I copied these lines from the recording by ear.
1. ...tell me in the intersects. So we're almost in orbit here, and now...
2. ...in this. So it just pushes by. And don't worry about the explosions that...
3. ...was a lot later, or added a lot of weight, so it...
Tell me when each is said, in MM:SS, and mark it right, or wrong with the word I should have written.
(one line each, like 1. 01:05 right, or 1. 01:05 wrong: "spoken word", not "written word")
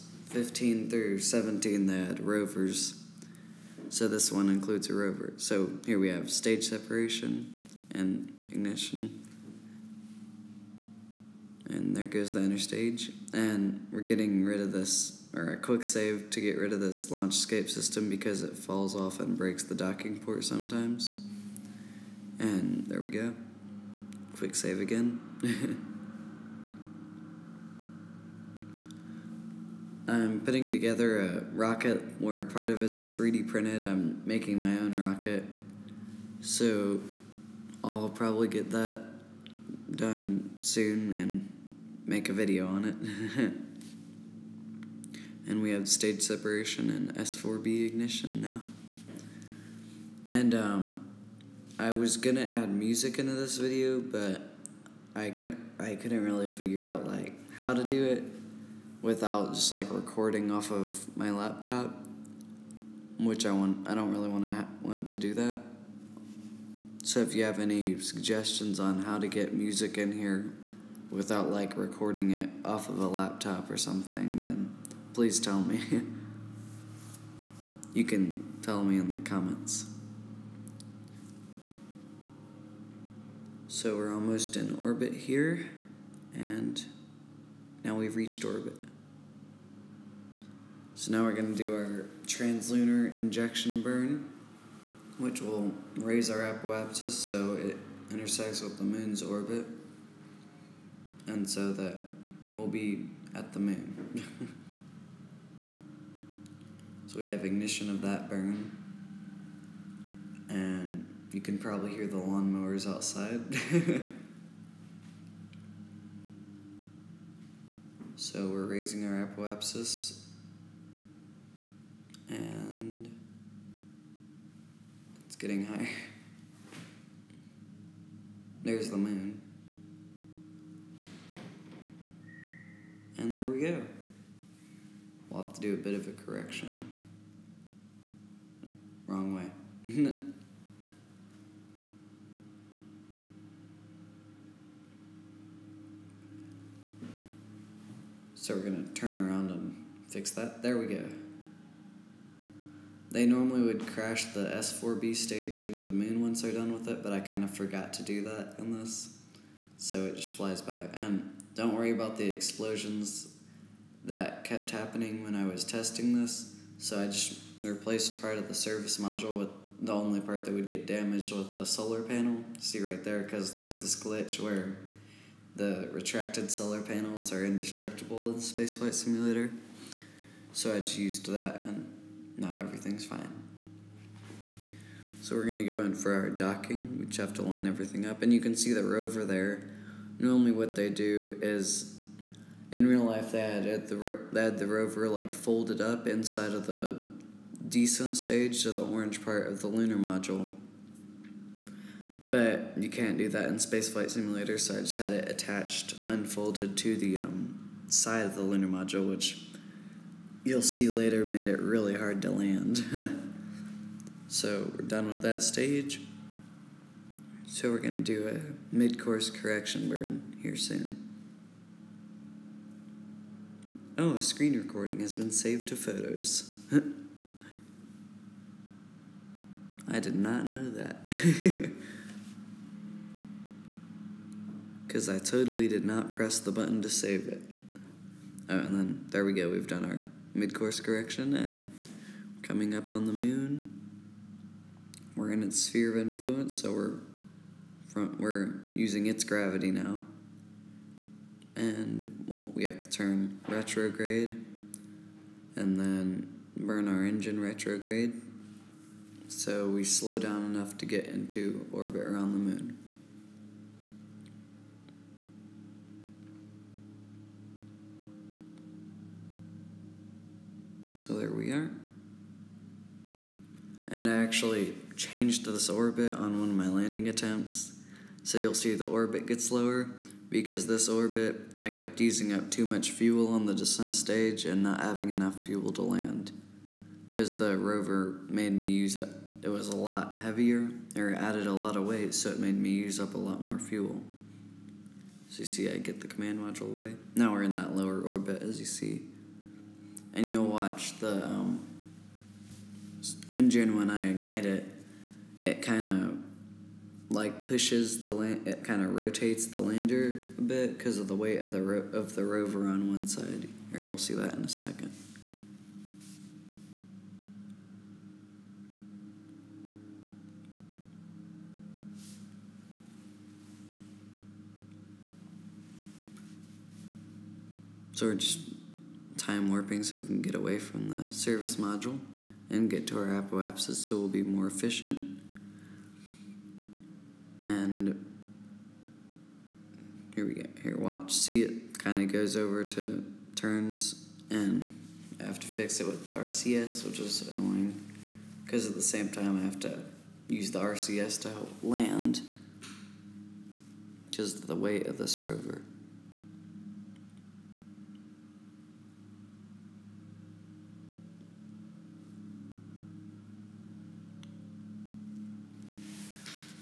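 1. 01:18 wrong: "comments", not "intersects"
2. 02:38 wrong: "flies", not "pushes"
3. 04:49 wrong: "heavier", not "later".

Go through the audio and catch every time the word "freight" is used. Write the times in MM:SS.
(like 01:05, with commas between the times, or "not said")
not said.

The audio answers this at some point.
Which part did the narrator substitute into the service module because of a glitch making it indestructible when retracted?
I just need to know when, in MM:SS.
02:51.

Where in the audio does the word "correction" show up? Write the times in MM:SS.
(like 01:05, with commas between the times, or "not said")
02:16, 03:39, 04:00.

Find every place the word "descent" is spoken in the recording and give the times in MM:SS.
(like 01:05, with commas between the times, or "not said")
03:17, 04:43.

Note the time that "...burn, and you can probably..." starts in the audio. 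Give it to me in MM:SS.
01:48.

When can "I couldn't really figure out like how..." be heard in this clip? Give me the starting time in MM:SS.
00:55.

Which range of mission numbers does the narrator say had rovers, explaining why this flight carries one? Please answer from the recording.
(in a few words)
15 through 17.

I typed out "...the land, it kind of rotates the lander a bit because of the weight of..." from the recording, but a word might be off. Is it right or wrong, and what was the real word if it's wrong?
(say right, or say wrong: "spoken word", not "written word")
right.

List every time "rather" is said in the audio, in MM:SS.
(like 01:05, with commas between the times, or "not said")
not said.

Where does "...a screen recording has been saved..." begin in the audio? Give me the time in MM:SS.
03:44.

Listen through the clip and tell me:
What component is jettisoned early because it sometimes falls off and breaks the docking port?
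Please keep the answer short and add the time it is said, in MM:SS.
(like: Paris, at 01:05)
launch escape system, at 00:17.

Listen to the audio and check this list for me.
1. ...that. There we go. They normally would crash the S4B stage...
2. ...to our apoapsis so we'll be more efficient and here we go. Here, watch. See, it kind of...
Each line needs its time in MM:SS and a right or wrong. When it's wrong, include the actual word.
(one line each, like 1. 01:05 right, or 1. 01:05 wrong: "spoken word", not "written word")
1. 02:30 right
2. 05:32 right.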